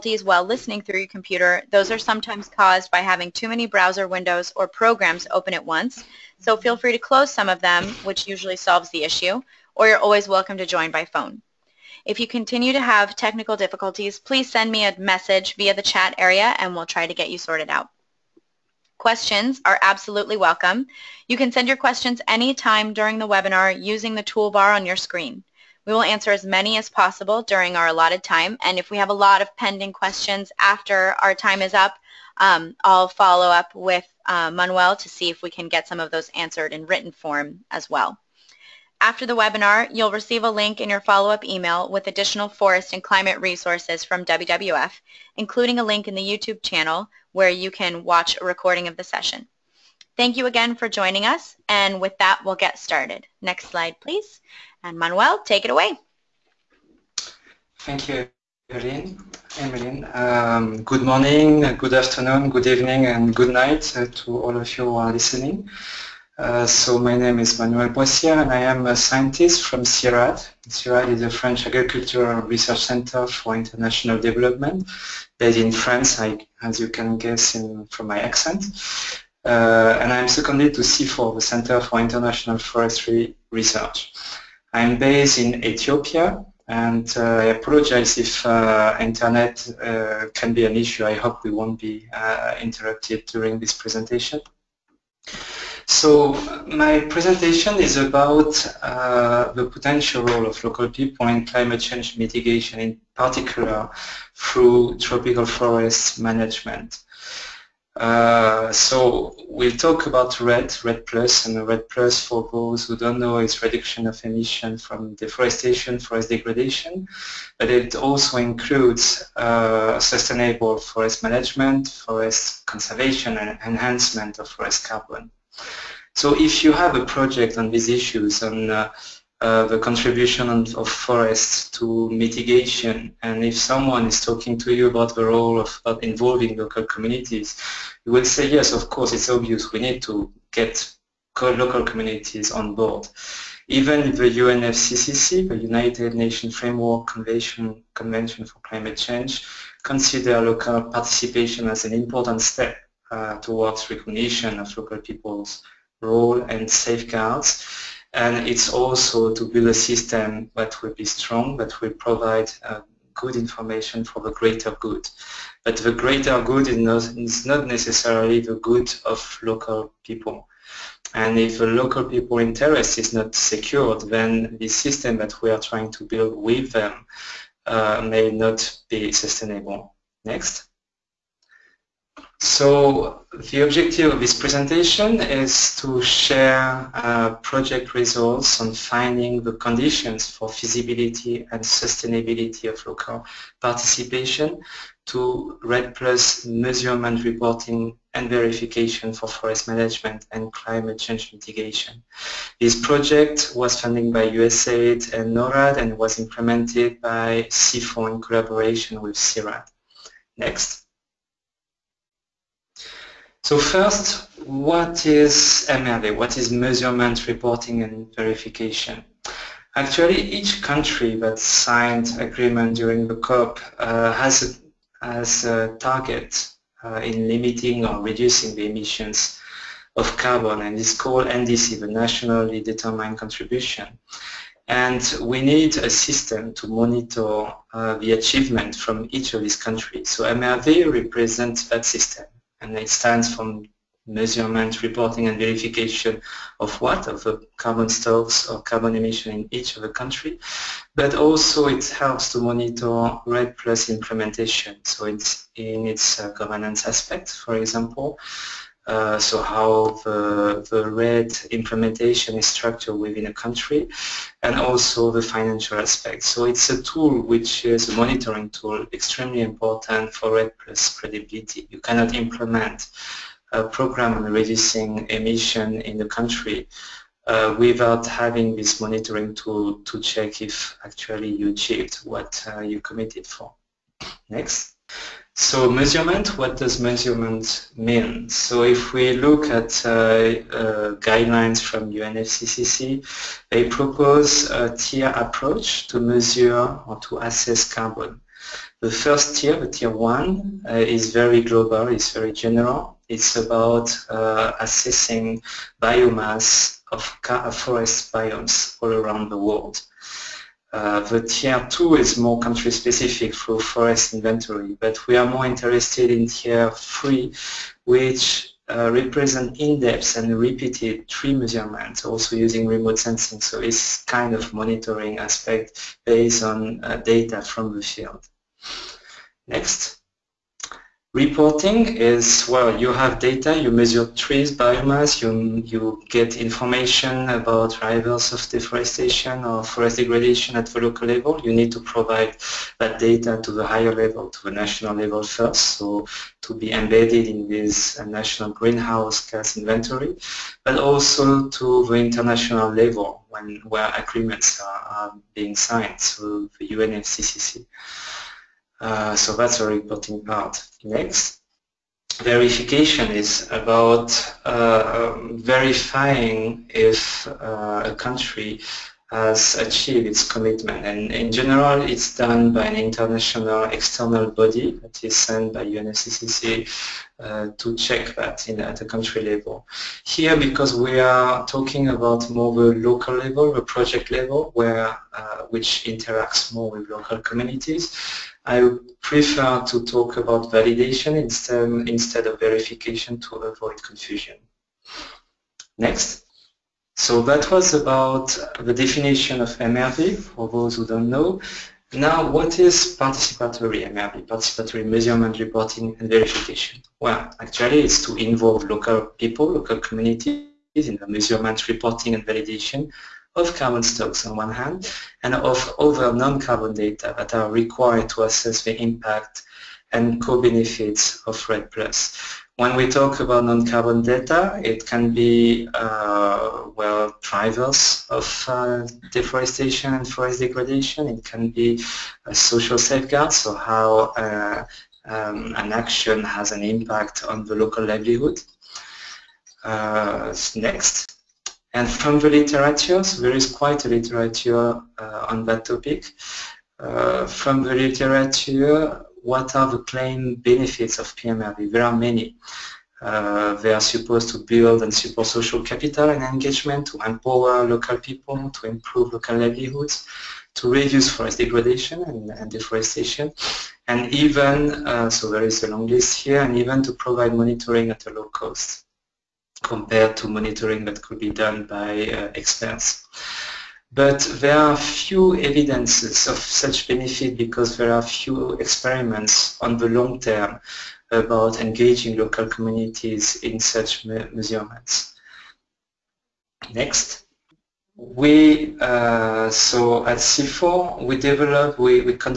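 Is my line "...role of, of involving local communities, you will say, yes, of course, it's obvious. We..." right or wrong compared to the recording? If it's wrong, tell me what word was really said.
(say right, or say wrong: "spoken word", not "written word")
right.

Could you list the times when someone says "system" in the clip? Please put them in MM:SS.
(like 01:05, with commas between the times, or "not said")
02:39, 02:54, 03:55, 04:01.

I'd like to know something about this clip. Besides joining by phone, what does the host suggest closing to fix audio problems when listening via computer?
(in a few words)
browser windows.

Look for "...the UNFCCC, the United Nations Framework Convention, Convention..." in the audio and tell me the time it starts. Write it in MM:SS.
02:24.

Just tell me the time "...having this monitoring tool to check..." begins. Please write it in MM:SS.
04:38.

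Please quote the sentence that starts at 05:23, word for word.
So it's kind of monitoring aspect based on uh, data from the field.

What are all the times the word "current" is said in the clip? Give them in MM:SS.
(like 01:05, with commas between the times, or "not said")
not said.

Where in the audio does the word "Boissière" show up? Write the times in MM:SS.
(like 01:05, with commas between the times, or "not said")
01:07.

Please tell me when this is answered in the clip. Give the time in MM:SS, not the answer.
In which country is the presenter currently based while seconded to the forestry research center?
01:25.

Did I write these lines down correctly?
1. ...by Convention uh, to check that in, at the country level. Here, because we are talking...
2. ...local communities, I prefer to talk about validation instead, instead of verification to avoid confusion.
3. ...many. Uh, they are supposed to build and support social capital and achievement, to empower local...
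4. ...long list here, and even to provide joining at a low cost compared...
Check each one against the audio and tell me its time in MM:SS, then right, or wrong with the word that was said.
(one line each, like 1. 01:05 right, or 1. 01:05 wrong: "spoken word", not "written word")
1. 06:15 wrong: "UNFCCC", not "Convention"
2. 06:26 right
3. 07:31 wrong: "engagement", not "achievement"
4. 07:45 wrong: "monitoring", not "joining".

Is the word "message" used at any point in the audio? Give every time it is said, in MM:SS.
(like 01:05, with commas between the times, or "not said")
00:14.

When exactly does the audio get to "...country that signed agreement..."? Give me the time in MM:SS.
03:40.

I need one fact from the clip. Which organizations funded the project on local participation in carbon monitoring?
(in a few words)
USAID and NORAD.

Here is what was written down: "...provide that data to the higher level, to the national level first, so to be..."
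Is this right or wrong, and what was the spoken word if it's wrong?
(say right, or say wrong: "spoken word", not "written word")
right.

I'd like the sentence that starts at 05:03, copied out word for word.
It's about uh, assessing biomass of forest biomes all around the world.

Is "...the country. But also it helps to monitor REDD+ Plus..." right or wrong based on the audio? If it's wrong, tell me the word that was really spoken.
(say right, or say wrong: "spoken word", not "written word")
right.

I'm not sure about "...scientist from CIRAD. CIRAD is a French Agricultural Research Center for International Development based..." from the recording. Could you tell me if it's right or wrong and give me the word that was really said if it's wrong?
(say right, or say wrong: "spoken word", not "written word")
right.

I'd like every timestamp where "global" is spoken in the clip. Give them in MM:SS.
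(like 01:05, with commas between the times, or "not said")
05:01.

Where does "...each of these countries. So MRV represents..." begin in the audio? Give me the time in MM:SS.
03:59.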